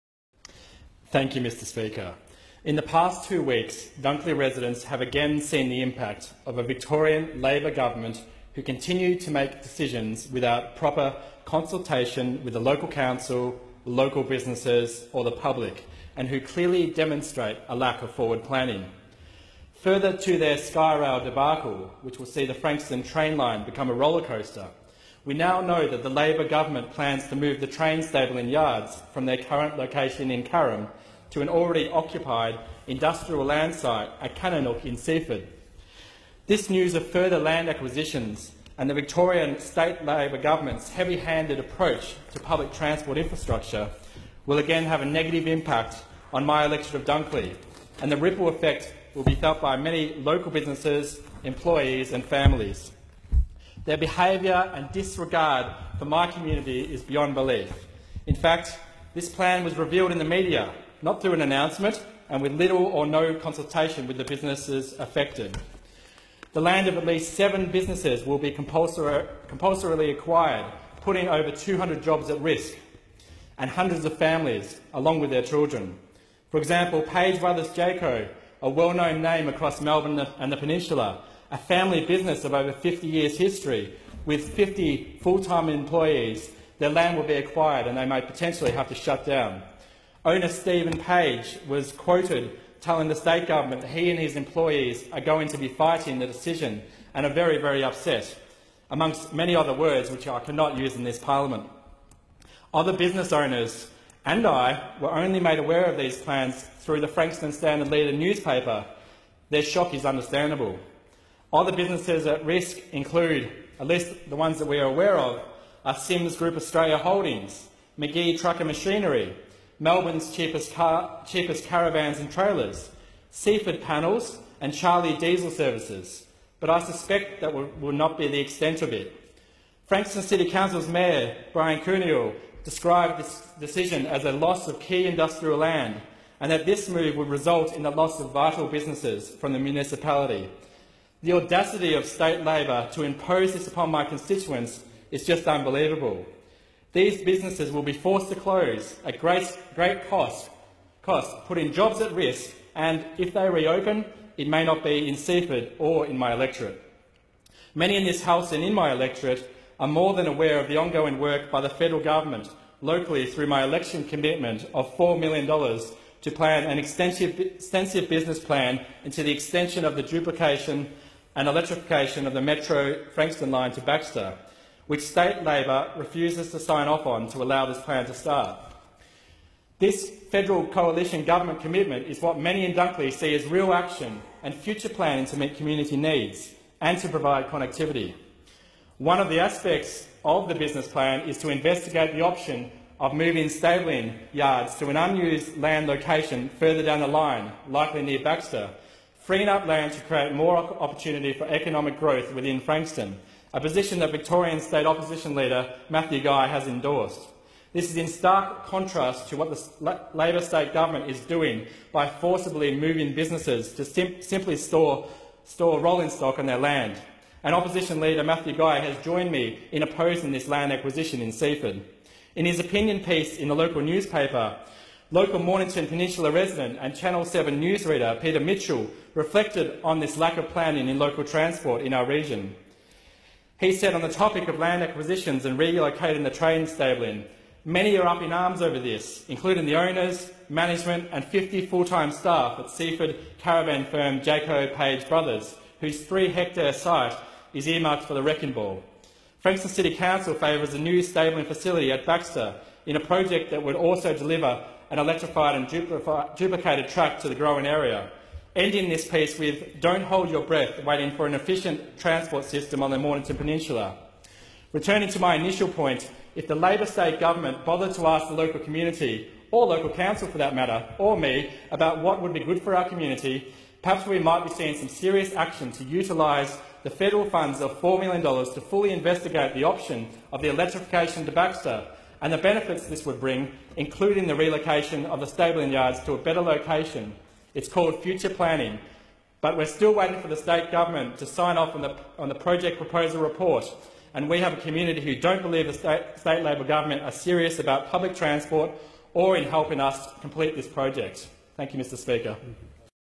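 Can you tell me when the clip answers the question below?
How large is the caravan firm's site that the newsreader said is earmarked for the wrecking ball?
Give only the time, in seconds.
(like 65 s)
246 s.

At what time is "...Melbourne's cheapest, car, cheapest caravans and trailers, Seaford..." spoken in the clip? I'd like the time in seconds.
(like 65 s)
119 s.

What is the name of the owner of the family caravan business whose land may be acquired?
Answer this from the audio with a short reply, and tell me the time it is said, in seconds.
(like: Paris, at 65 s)
Stephen Page, at 90 s.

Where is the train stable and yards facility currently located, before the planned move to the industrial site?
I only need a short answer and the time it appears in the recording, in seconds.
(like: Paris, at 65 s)
Carrum, at 30 s.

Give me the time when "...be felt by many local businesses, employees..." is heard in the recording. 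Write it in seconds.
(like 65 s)
49 s.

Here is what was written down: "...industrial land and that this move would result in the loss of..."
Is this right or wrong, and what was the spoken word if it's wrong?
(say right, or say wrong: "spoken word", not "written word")
right.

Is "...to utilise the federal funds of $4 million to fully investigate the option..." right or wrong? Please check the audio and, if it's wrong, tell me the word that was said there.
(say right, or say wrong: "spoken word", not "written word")
right.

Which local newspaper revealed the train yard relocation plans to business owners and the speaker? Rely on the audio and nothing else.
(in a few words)
Frankston Standard Leader.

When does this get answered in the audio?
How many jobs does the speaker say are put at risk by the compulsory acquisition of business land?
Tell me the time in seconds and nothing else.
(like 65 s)
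71 s.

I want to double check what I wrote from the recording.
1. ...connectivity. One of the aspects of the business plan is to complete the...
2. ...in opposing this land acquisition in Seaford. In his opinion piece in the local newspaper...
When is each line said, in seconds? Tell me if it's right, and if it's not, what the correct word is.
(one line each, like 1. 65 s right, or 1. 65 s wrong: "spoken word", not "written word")
1. 187 s wrong: "investigate", not "complete"
2. 219 s right.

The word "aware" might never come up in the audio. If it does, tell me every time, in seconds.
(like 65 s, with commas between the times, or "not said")
105 s, 114 s, 160 s.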